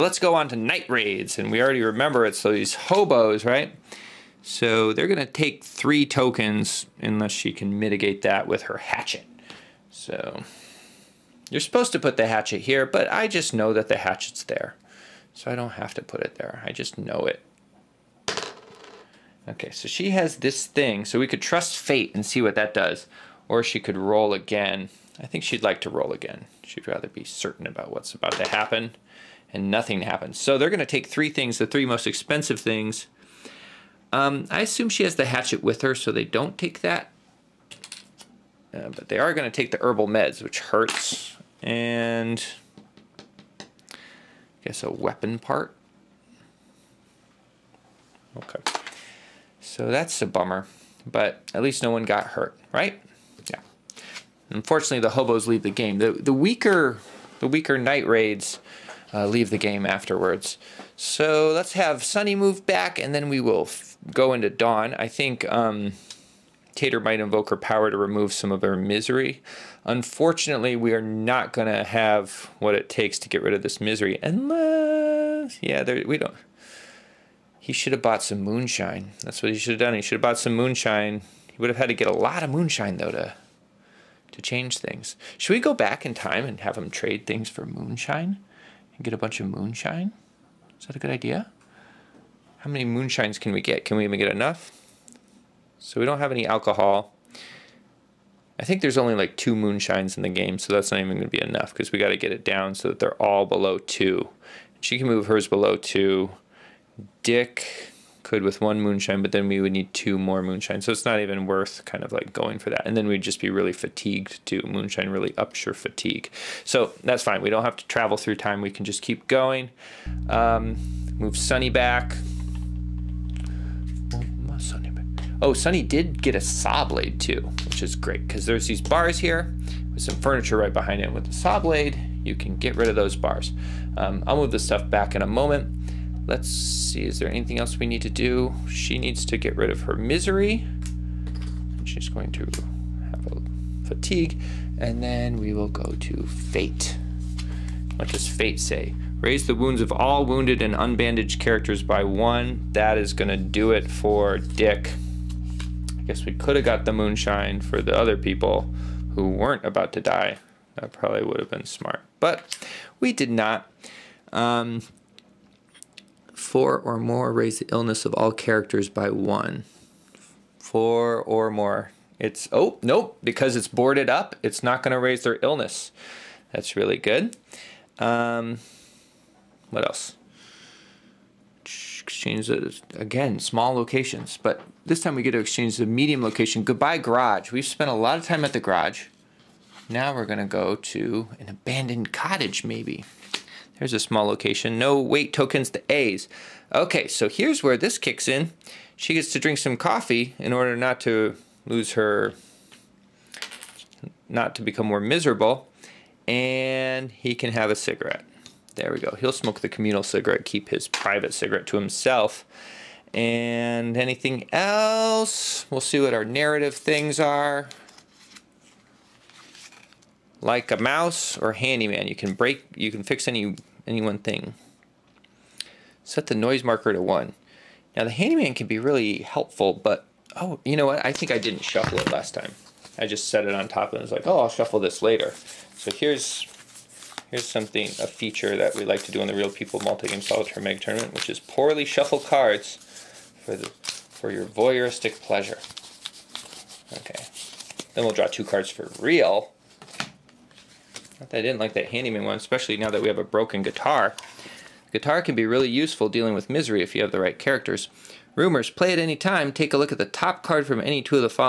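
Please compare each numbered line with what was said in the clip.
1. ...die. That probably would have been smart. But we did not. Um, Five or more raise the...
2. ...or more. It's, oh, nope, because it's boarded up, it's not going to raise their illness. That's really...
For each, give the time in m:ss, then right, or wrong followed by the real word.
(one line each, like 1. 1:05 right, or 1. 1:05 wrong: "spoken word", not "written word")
1. 2:40 wrong: "Four", not "Five"
2. 2:51 right.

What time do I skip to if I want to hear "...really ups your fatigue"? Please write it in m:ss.
1:55.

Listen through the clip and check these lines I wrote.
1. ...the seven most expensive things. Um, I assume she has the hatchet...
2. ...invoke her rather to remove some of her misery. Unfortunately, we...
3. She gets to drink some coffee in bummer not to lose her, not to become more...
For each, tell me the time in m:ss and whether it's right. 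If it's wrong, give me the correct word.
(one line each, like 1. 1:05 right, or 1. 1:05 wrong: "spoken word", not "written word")
1. 0:31 wrong: "three", not "seven"
2. 1:07 wrong: "power", not "rather"
3. 3:18 wrong: "order", not "bummer".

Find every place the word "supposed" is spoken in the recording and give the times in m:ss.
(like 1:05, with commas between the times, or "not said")
0:11.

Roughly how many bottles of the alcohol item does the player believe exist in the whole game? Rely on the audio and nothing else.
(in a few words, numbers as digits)
2.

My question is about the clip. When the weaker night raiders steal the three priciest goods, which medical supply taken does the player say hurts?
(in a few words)
herbal meds.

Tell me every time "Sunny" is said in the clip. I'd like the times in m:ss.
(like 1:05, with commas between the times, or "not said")
1:02, 2:01, 2:05.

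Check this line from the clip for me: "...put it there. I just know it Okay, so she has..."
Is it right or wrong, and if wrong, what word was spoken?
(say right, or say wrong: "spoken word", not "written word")
right.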